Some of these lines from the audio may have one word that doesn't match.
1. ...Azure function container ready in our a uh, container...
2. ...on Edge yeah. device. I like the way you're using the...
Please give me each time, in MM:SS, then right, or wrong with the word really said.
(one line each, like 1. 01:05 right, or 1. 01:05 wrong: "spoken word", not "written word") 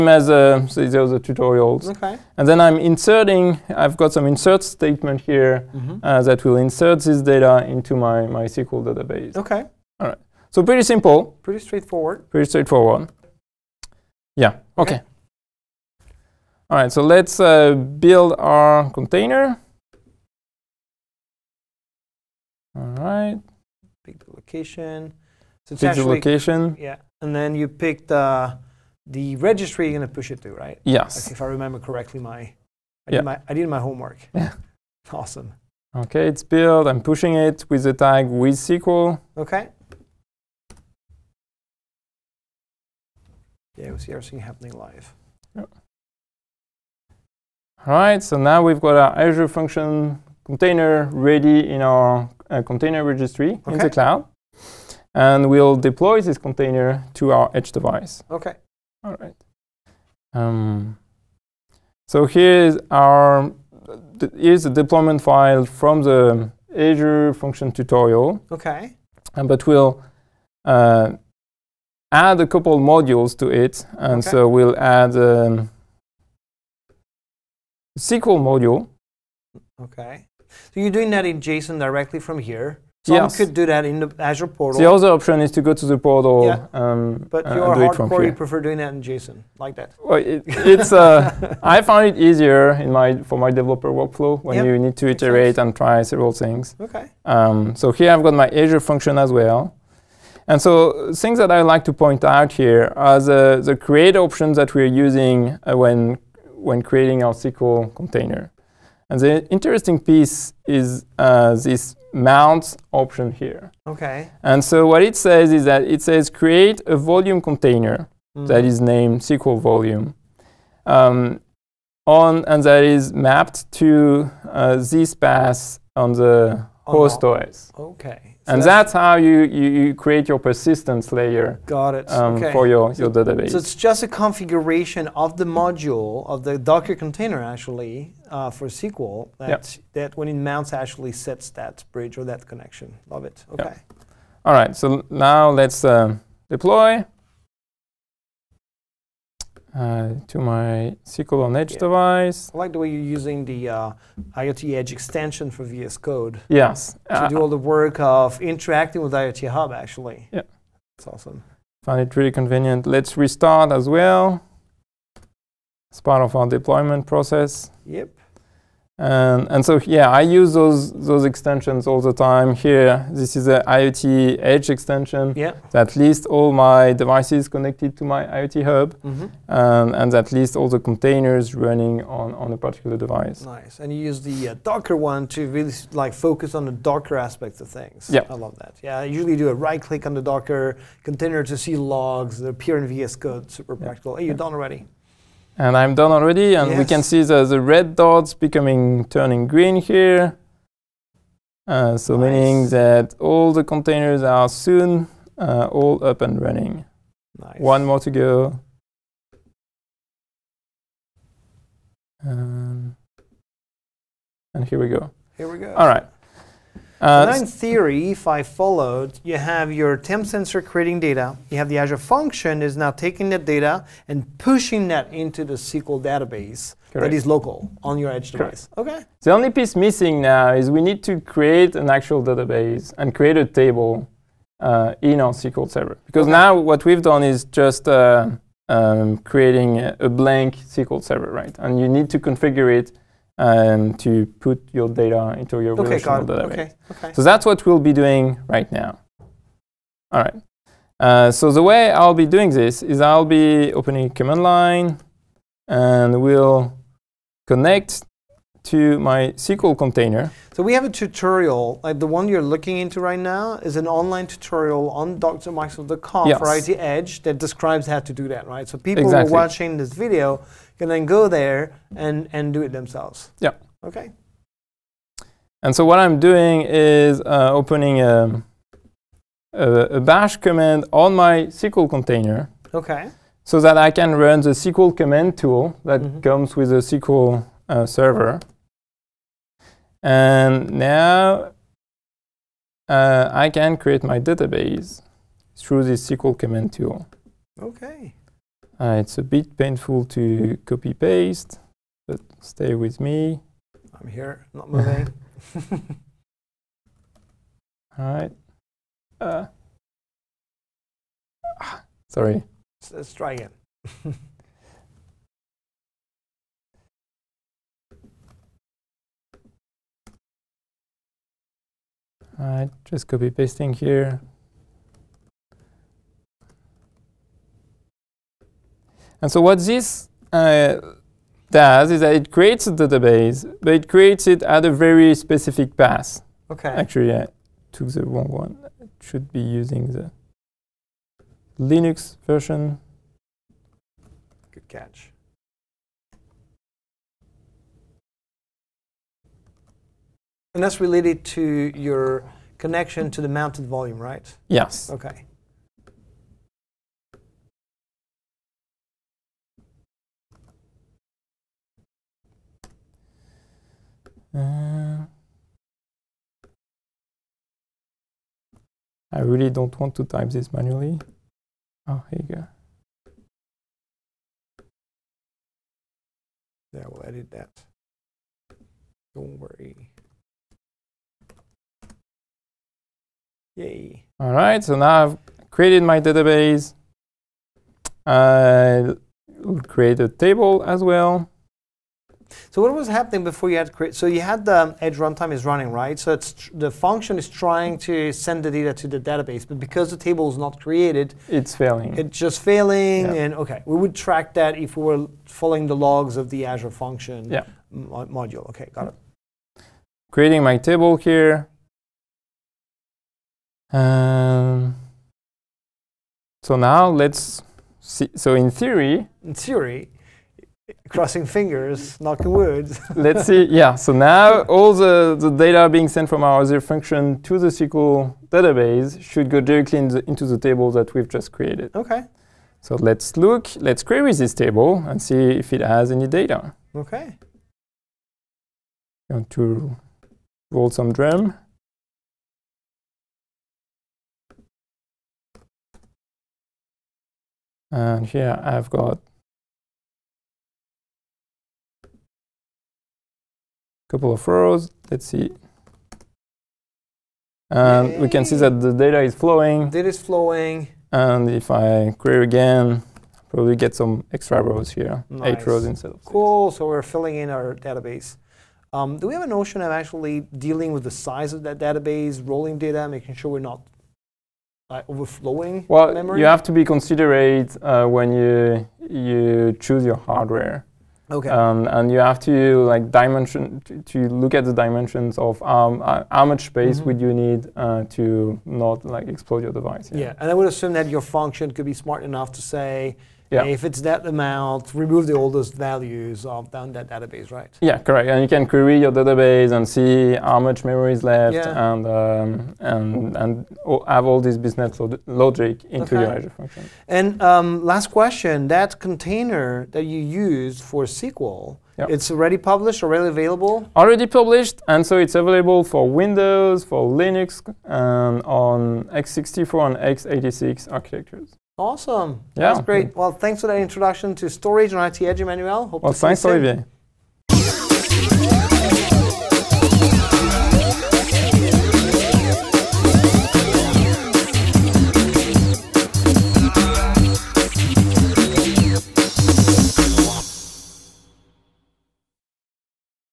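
1. 00:49 right
2. 02:31 right.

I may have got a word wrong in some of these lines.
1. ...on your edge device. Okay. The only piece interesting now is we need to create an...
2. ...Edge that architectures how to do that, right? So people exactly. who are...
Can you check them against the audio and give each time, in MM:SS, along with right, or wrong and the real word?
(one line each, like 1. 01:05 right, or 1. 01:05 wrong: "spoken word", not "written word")
1. 03:47 wrong: "missing", not "interesting"
2. 04:26 wrong: "describes", not "architectures".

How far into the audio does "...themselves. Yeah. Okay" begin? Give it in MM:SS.
04:32.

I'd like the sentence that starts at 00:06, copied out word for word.
uh, that will insert this data into my, my SQL database.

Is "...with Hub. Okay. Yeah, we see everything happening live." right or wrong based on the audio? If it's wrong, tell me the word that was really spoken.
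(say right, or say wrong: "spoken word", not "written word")
wrong: "SQL", not "Hub".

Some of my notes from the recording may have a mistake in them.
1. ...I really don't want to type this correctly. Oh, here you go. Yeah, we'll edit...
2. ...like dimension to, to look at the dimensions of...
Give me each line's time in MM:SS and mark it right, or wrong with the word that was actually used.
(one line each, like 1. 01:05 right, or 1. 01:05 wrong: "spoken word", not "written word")
1. 06:09 wrong: "manually", not "correctly"
2. 08:02 right.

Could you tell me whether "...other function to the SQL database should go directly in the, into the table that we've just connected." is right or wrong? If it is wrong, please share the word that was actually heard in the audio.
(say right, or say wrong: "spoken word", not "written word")
wrong: "created", not "connected".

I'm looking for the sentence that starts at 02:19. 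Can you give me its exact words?
that when it mounts actually sets that bridge or that connection.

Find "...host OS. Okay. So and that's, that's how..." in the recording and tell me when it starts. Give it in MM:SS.
02:06.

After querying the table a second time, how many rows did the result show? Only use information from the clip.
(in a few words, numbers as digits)
8.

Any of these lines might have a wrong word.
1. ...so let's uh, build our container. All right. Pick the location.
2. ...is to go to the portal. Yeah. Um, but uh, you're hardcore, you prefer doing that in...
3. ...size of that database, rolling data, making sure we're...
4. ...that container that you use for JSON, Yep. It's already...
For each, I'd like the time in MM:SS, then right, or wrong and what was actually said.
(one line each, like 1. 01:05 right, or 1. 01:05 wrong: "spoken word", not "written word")
1. 00:16 right
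2. 01:25 right
3. 07:50 right
4. 08:28 wrong: "SQL", not "JSON".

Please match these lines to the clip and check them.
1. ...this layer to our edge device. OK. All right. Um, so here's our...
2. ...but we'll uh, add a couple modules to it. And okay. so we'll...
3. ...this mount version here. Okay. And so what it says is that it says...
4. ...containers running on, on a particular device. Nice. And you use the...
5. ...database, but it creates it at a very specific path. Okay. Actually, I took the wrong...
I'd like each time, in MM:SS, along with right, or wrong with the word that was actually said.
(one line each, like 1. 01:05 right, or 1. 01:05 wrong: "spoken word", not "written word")
1. 00:56 wrong: "container", not "layer"
2. 01:09 right
3. 01:51 wrong: "option", not "version"
4. 03:00 right
5. 05:32 right.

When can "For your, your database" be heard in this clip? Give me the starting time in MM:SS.
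02:12.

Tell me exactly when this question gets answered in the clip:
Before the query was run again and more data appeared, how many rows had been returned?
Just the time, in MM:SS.
07:46.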